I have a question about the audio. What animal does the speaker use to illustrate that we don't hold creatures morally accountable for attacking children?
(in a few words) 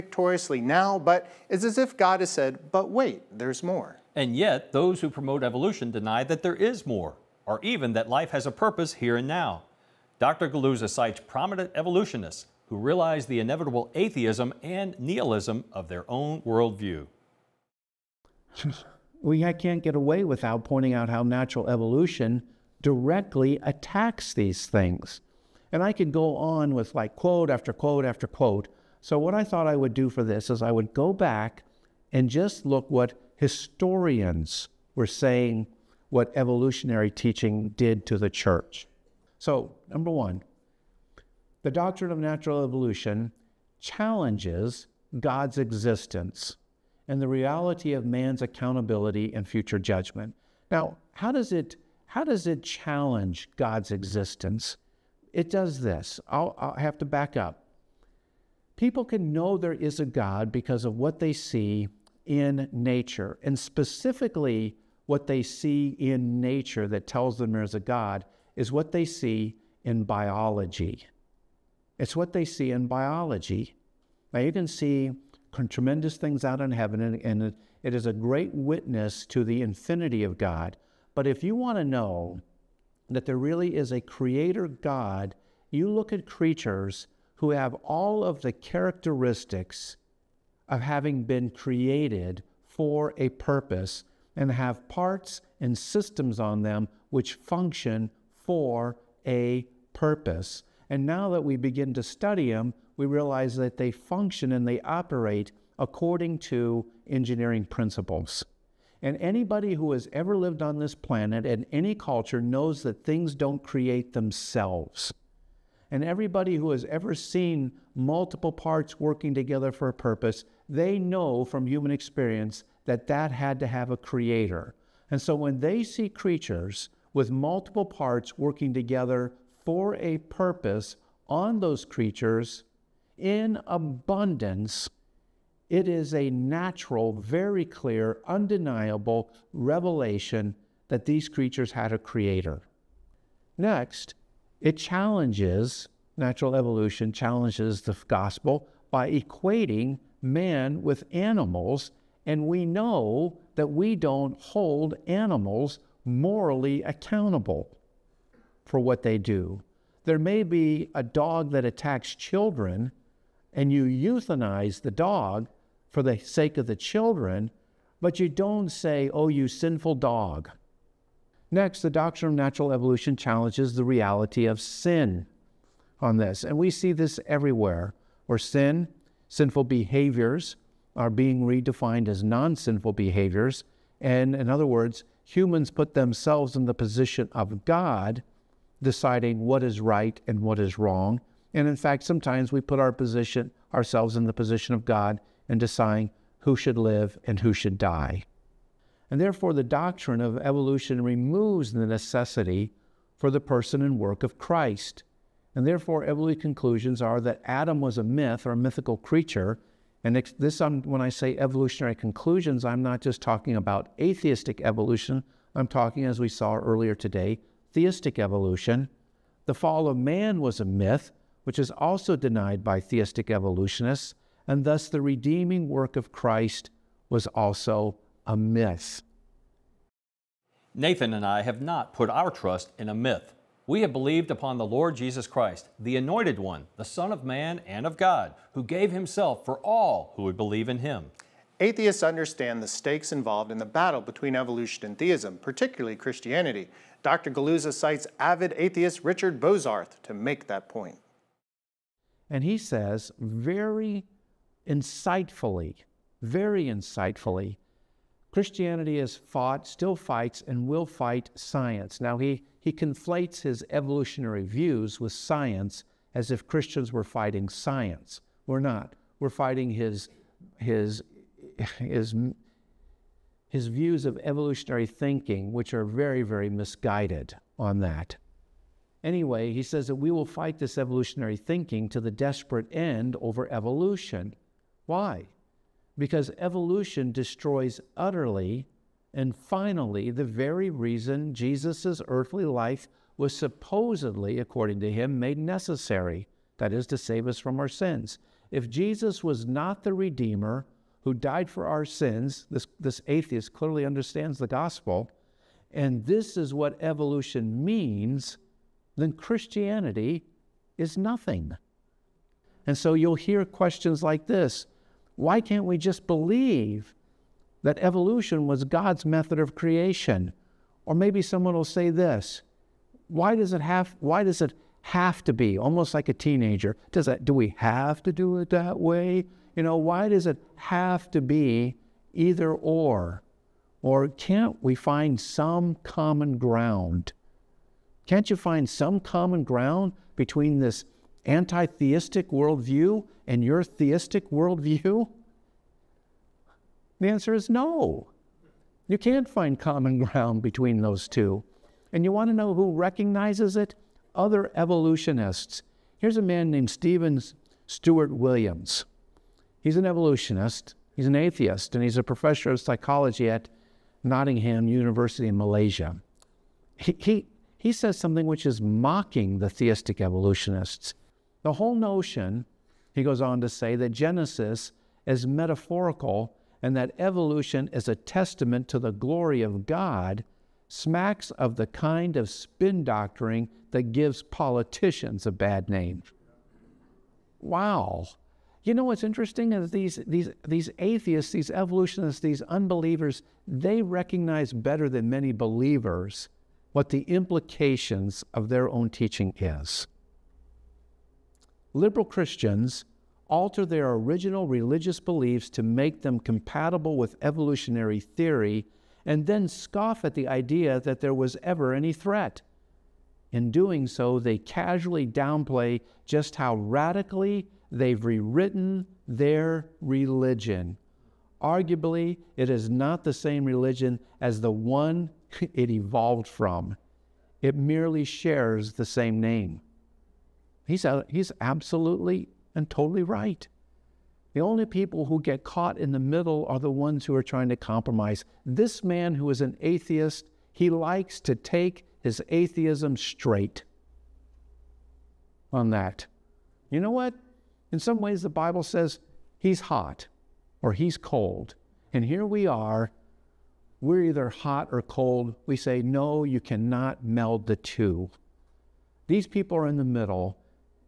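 A dog.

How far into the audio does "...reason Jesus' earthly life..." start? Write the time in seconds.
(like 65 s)
290 s.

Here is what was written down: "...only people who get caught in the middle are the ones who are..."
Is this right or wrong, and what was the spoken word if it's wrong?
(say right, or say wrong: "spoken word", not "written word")
right.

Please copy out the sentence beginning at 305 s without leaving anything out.
And this is what evolution means, then Christianity is nothing.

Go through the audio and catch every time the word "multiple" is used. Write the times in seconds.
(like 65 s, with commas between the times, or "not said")
117 s, 127 s.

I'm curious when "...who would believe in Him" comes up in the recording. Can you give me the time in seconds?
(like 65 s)
240 s.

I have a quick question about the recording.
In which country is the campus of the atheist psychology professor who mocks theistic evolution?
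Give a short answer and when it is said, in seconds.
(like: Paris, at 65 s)
Malaysia, at 365 s.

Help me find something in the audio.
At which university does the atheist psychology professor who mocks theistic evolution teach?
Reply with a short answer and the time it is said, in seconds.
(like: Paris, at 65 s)
Nottingham University, at 364 s.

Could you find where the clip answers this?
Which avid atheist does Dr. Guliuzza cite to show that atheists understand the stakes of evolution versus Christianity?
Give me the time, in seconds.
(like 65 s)
249 s.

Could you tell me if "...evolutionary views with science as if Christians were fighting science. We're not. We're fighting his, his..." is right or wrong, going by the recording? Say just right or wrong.
right.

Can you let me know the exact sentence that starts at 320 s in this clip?
Or maybe someone will say this Why does it have, why does it have to be, almost like a teenager?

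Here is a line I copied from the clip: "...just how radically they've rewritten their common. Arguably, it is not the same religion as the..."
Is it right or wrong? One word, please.
wrong.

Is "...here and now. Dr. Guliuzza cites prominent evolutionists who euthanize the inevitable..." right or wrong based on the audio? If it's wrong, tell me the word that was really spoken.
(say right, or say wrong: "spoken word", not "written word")
wrong: "realize", not "euthanize".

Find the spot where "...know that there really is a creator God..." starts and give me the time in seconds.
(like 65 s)
81 s.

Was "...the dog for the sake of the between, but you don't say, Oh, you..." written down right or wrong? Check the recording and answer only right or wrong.
wrong.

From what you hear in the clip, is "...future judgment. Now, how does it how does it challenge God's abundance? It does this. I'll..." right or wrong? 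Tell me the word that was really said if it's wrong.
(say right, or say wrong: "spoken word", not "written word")
wrong: "existence", not "abundance".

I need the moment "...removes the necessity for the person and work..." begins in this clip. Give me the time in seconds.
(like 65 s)
201 s.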